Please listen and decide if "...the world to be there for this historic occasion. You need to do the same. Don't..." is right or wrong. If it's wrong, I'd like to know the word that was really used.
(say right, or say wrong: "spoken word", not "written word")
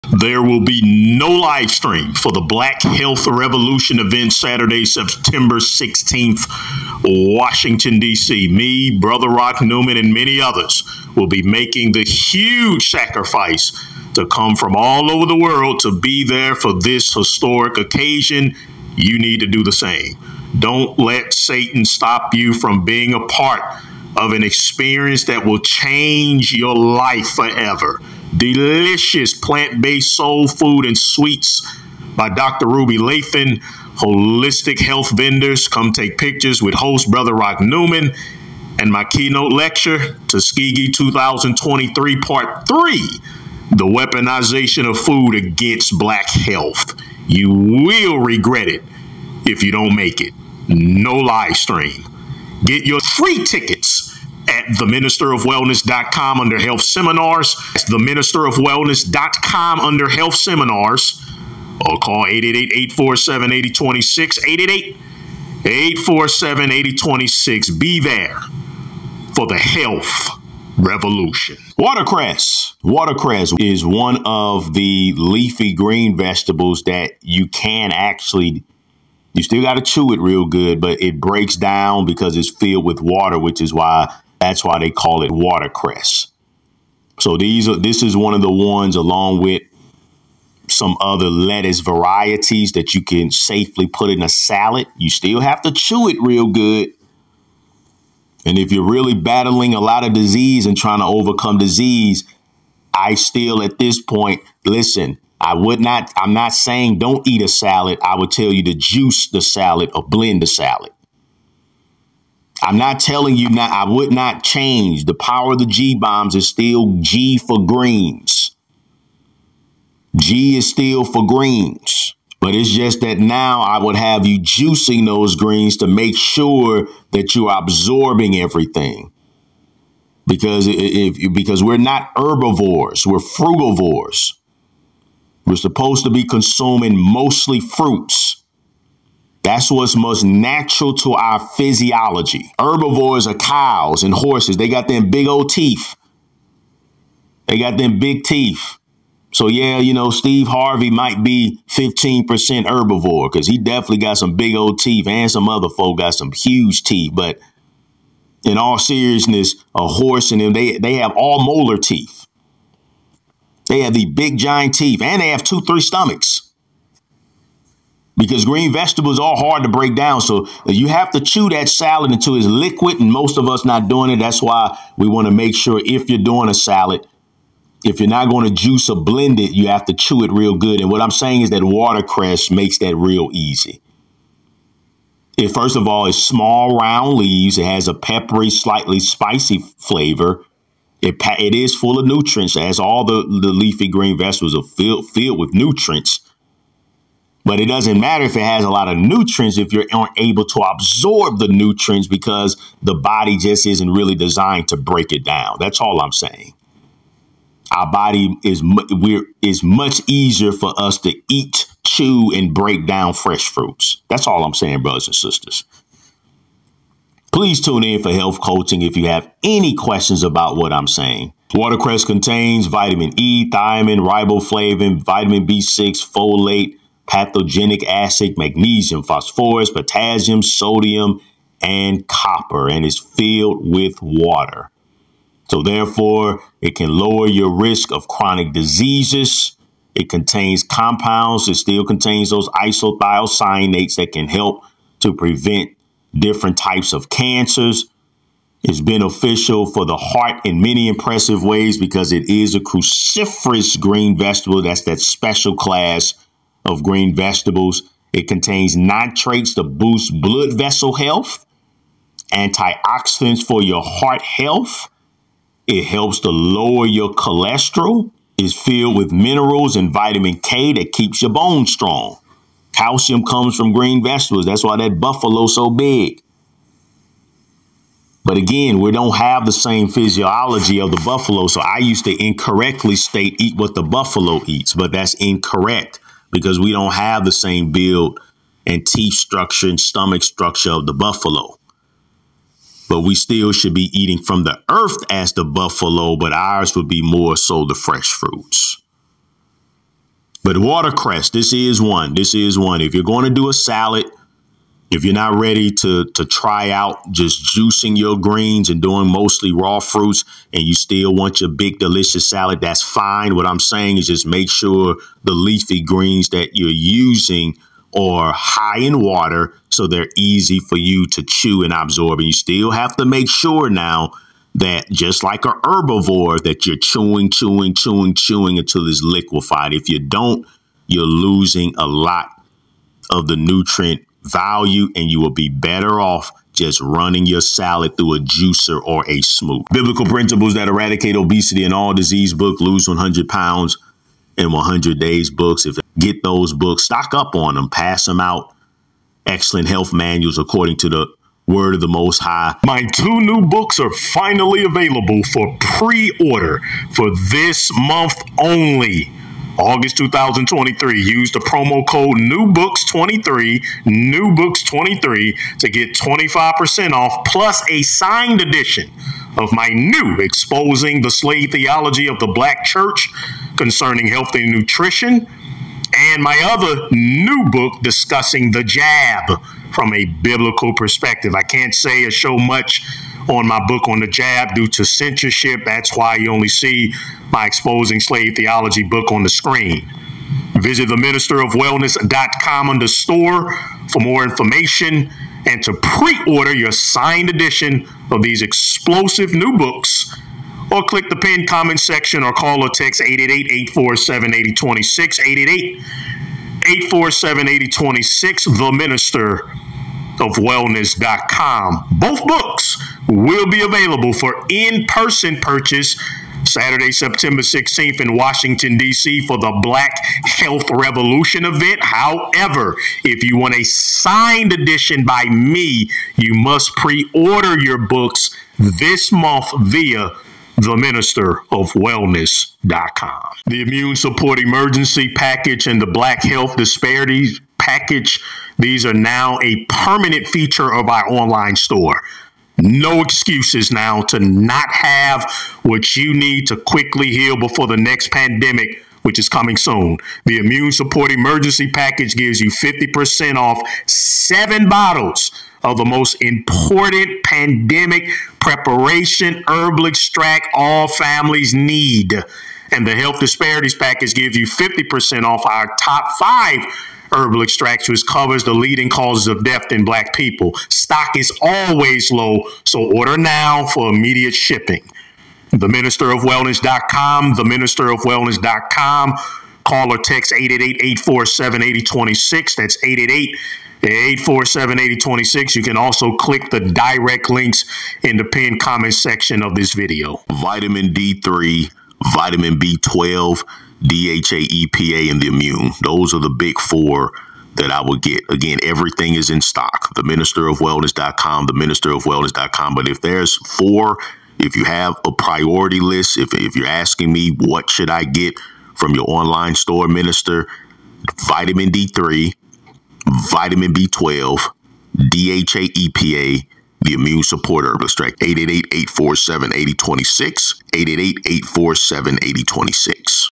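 right.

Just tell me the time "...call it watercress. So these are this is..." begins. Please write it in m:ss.
1:24.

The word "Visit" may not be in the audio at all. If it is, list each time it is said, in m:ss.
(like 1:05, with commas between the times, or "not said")
6:30.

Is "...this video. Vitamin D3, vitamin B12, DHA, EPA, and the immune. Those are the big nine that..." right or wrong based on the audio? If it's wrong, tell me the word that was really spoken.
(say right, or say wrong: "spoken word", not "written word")
wrong: "four", not "nine".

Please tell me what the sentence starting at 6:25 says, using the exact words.
That's why you only see my Exposing Slave Theology book on the screen.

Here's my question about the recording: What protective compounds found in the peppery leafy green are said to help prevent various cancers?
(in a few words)
isothiocyanates.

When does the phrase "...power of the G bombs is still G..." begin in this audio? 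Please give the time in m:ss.
1:55.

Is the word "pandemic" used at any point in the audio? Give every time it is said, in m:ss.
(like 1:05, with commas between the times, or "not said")
7:28, 7:37.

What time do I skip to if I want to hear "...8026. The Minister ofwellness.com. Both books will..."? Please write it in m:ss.
6:47.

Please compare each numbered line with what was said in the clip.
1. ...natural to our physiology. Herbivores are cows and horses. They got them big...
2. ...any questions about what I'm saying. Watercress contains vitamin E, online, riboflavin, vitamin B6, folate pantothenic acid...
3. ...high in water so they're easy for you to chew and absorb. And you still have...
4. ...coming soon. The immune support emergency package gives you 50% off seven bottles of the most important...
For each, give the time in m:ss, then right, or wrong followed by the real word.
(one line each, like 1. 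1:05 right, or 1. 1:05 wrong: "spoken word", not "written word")
1. 2:20 right
2. 3:39 wrong: "thiamine", not "online"
3. 5:18 right
4. 7:29 right.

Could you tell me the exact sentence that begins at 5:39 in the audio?
Biblical principles that eradicate obesity and all disease book, lose 100 pounds in 100 days books.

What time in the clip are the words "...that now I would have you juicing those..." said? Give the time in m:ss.
2:03.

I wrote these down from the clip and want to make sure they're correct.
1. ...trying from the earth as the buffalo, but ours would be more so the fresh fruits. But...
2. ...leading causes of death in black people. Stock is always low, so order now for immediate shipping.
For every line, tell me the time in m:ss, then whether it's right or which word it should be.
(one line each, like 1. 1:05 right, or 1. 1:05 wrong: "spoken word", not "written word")
1. 4:53 wrong: "eating", not "trying"
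2. 7:48 right.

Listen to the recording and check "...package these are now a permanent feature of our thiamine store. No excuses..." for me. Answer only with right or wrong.
wrong.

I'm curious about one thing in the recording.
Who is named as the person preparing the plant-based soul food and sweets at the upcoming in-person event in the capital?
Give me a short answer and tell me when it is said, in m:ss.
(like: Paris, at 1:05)
Dr. Ruby Lathon, at 0:32.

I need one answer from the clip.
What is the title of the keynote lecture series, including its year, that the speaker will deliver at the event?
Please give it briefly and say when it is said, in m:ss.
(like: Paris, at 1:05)
Tuskegee 2023, at 0:40.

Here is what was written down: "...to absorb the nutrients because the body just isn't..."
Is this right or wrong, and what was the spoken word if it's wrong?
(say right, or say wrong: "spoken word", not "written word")
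right.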